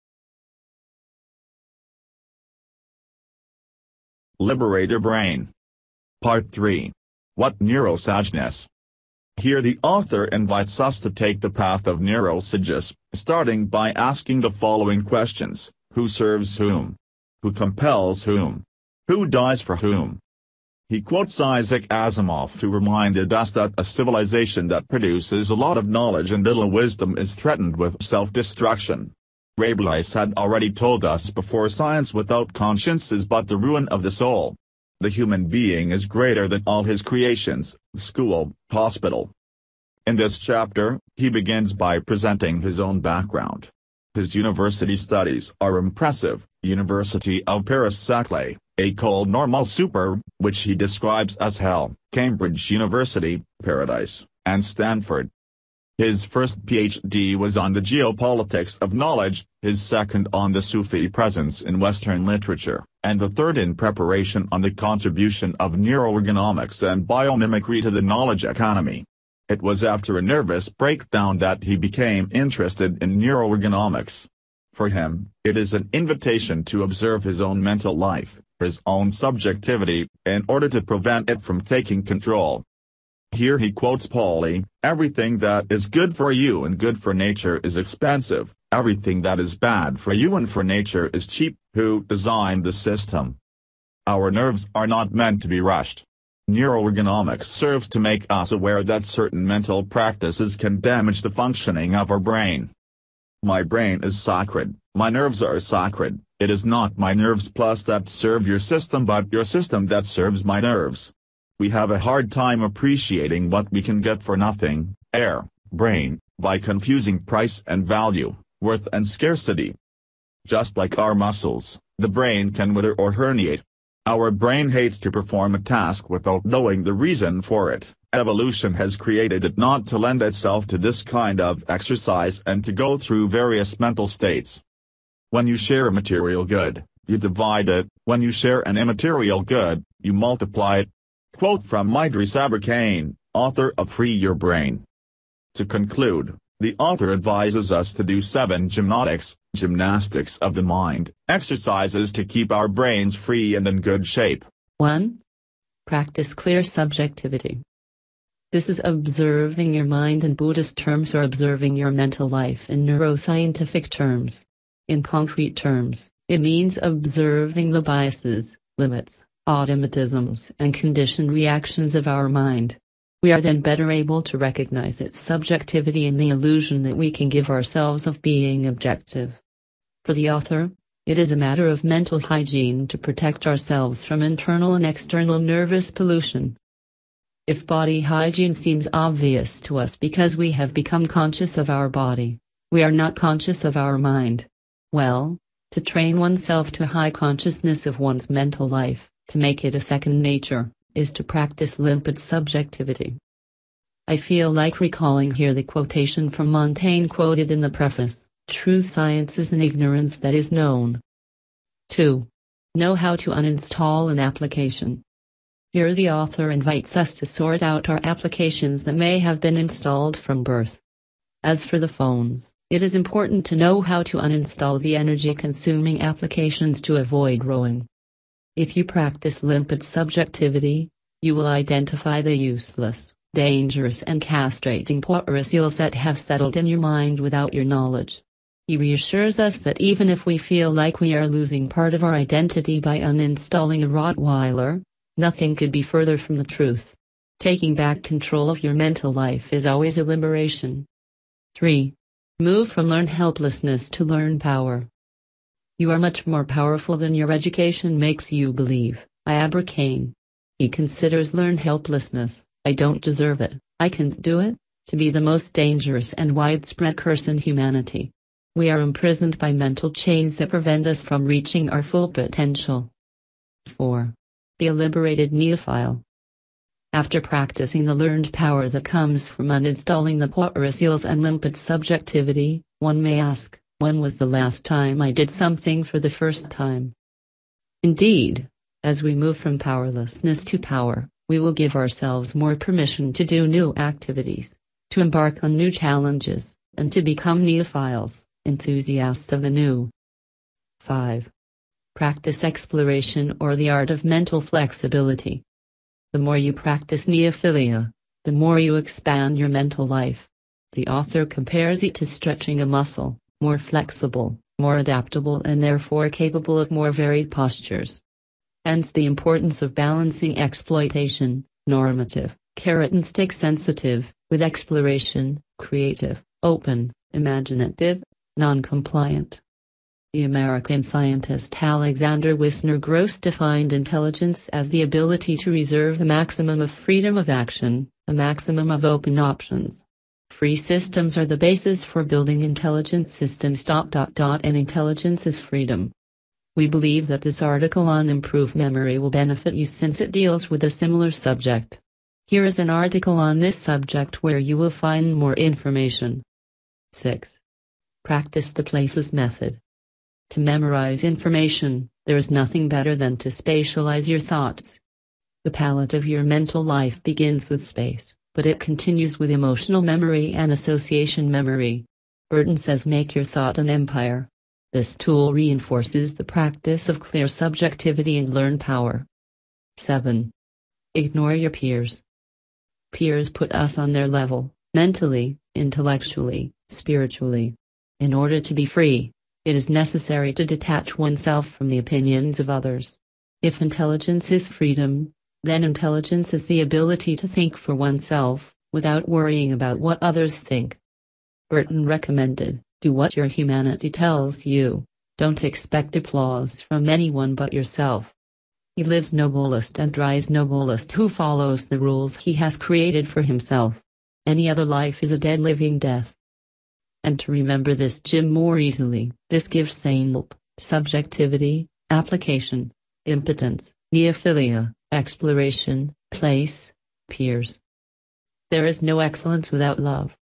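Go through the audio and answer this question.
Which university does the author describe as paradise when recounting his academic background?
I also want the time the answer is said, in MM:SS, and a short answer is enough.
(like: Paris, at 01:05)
Cambridge University, at 00:52.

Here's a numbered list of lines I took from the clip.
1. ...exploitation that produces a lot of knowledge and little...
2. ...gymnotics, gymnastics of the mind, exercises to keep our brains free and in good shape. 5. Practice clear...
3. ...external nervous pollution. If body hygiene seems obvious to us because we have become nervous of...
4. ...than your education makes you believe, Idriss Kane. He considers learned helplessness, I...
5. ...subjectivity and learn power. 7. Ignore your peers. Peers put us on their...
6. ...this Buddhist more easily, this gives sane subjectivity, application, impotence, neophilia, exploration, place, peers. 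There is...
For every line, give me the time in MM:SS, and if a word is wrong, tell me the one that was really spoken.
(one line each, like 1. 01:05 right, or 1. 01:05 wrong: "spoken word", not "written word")
1. 00:23 wrong: "civilization", not "exploitation"
2. 02:28 wrong: "1", not "5"
3. 03:04 wrong: "conscious", not "nervous"
4. 04:16 wrong: "Iabra", not "Idriss"
5. 06:17 right
6. 06:57 wrong: "Jim", not "Buddhist".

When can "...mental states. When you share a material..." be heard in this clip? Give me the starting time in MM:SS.
02:13.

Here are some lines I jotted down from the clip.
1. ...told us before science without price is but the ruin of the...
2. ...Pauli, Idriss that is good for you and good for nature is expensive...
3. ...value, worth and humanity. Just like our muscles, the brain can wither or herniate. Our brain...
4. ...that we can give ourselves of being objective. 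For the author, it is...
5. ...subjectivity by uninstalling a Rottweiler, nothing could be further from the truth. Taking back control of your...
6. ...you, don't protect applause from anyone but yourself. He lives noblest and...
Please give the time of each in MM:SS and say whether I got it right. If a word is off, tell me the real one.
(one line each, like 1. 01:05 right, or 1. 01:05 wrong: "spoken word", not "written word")
1. 00:30 wrong: "conscience", not "price"
2. 01:24 wrong: "Everything", not "Idriss"
3. 01:57 wrong: "scarcity", not "humanity"
4. 02:56 right
5. 04:02 wrong: "identity", not "subjectivity"
6. 06:44 wrong: "expect", not "protect".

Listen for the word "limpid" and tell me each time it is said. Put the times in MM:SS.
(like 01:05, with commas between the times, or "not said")
03:21, 03:49, 04:41.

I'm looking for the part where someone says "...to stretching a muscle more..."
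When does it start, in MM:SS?
05:11.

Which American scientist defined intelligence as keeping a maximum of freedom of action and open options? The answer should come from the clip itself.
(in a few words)
Alexander Wissner-Gross.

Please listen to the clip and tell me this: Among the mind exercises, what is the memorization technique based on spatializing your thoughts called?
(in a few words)
The places method.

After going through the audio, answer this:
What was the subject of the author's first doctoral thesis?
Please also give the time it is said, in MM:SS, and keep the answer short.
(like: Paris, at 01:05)
Geopolitics of knowledge, at 00:57.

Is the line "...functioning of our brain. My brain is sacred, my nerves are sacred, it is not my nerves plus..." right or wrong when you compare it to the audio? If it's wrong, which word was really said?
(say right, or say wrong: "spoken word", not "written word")
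right.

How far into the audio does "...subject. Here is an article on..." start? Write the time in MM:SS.
05:51.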